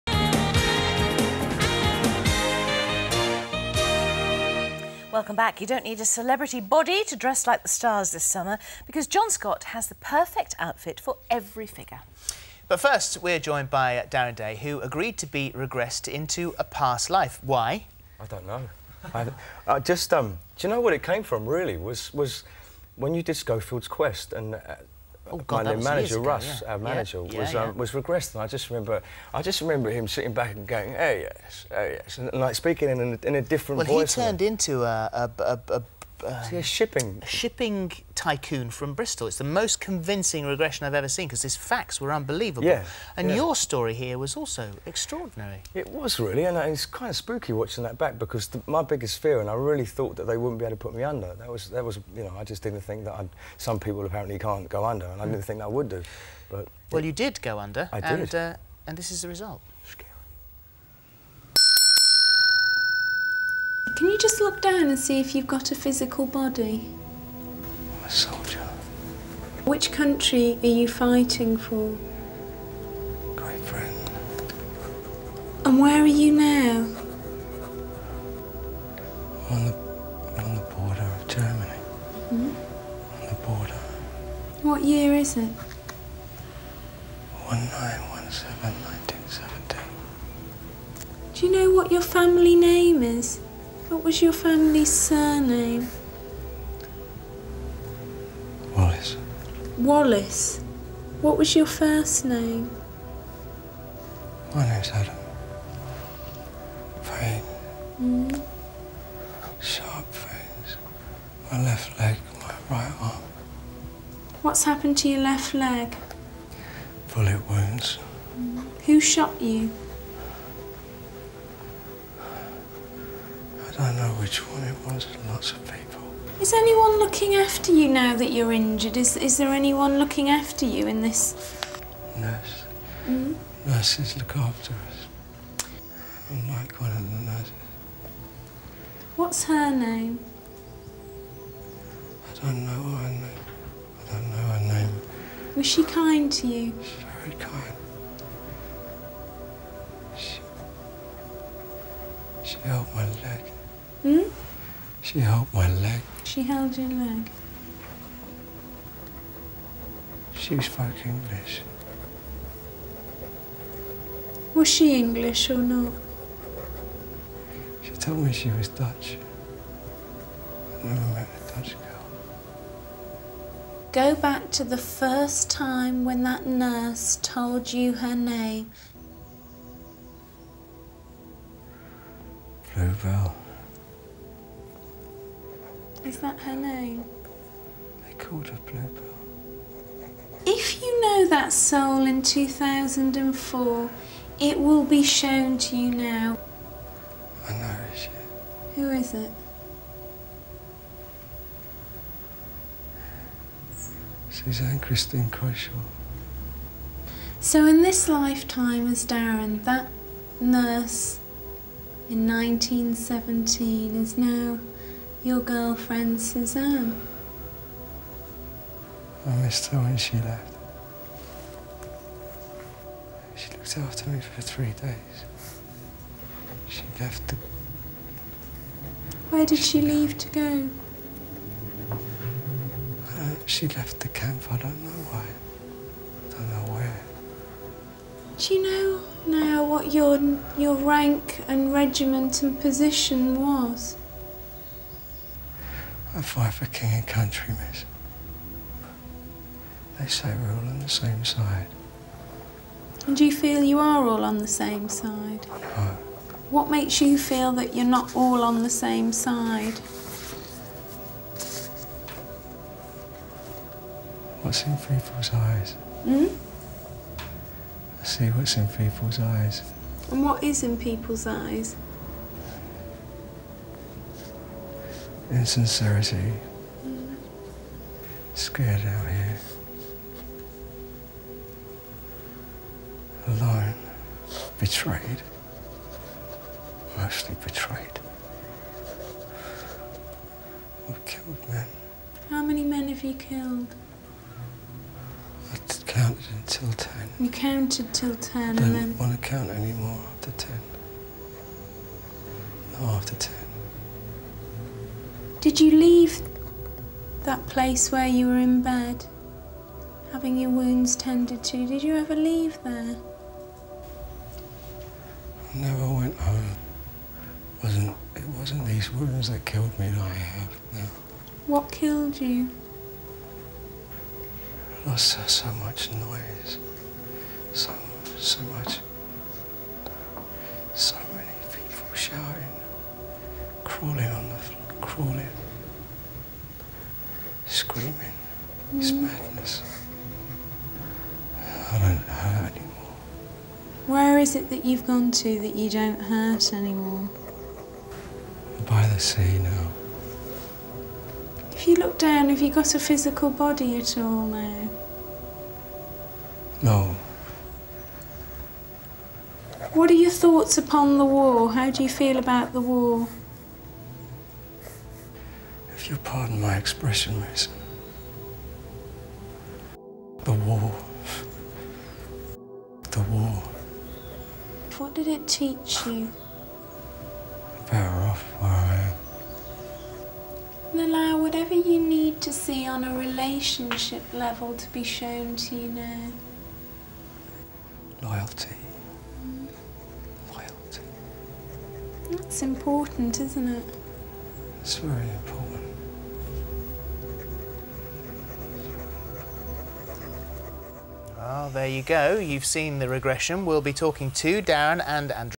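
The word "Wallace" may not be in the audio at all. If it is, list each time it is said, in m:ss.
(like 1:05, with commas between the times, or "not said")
1:39.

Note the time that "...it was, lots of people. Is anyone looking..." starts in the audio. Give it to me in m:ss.
2:04.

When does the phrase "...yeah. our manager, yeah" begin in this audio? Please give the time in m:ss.
0:26.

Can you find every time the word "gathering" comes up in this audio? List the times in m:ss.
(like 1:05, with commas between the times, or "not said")
not said.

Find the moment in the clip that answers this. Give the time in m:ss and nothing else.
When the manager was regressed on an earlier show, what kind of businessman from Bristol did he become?
0:36.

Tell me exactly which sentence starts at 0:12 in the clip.
But first, we're joined by Darren Day, who agreed to be regressed into a past life.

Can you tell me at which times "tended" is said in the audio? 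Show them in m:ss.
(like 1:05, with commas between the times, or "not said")
5:10.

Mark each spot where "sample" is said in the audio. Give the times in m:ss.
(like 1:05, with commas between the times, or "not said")
not said.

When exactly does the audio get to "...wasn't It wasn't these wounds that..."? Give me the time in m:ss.
5:17.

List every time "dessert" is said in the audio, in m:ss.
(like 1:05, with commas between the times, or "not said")
not said.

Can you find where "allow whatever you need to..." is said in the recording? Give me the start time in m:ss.
6:20.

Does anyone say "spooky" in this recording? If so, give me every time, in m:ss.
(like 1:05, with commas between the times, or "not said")
0:47.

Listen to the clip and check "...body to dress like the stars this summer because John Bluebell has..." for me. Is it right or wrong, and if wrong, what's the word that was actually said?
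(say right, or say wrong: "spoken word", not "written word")
wrong: "Scott", not "Bluebell".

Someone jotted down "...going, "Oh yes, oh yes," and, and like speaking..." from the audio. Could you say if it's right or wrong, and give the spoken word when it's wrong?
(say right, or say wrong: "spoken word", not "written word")
right.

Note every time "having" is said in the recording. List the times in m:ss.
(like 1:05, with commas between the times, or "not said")
5:10.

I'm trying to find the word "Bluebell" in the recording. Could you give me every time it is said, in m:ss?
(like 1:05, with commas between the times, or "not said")
3:02, 3:08.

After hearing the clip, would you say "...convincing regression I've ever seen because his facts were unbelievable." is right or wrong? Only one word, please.
right.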